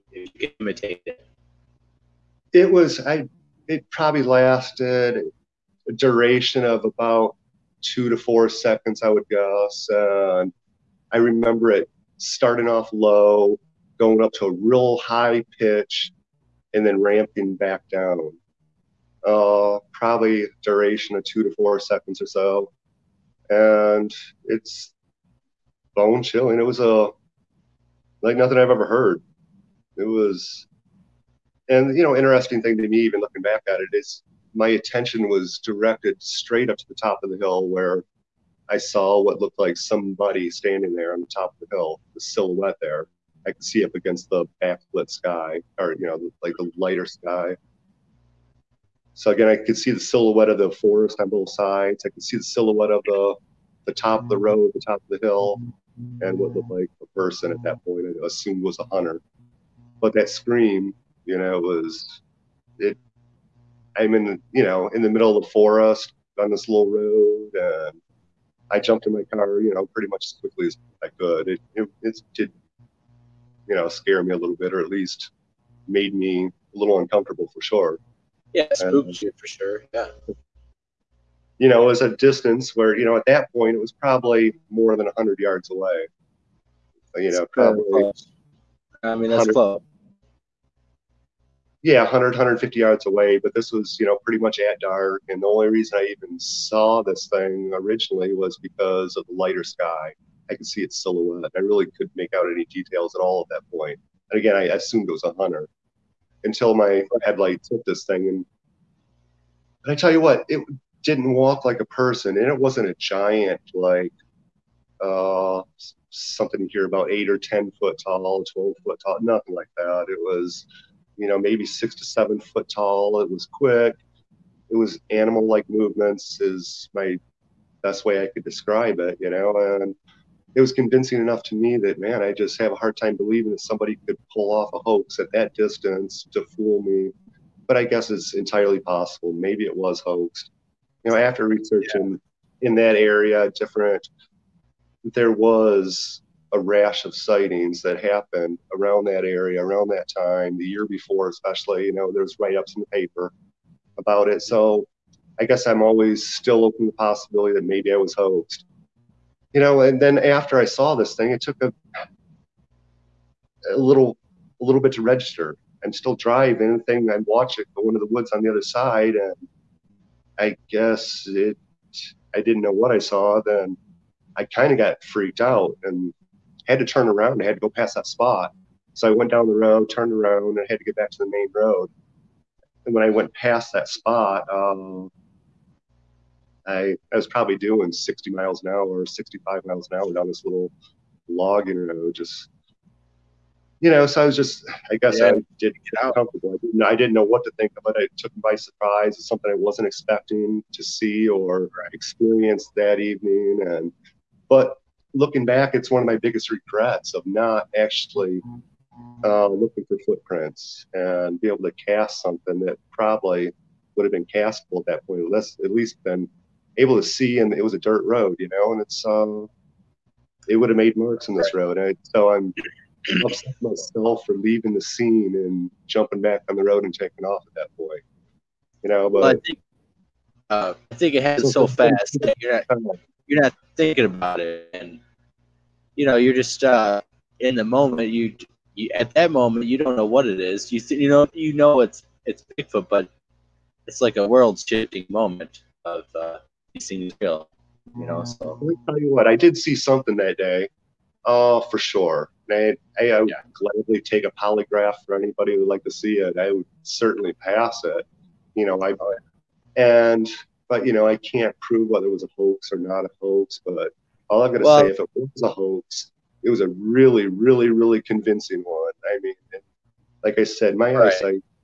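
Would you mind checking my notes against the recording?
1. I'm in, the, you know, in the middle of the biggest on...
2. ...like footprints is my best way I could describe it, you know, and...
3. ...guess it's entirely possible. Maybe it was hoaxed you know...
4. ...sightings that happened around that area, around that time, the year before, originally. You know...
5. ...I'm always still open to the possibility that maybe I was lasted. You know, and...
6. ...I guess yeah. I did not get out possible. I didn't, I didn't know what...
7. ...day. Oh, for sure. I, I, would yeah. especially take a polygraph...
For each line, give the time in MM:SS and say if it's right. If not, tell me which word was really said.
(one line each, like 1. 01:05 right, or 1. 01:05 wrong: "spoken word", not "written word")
1. 01:03 wrong: "forest", not "biggest"
2. 02:05 wrong: "movements", not "footprints"
3. 02:17 right
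4. 02:27 wrong: "especially", not "originally"
5. 02:35 wrong: "hoaxed", not "lasted"
6. 03:14 wrong: "comfortable", not "possible"
7. 04:10 wrong: "gladly", not "especially".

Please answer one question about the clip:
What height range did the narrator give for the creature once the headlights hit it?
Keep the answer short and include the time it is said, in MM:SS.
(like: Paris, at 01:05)
6 to 7 feet, at 02:01.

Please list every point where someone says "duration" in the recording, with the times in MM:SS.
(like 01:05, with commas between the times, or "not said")
00:05, 00:20.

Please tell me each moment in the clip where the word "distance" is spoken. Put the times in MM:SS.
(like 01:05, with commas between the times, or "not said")
01:22, 02:15.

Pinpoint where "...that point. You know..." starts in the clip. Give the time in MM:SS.
03:47.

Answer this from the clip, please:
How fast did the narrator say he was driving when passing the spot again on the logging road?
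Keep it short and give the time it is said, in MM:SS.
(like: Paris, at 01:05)
60 to 65 mph, at 03:07.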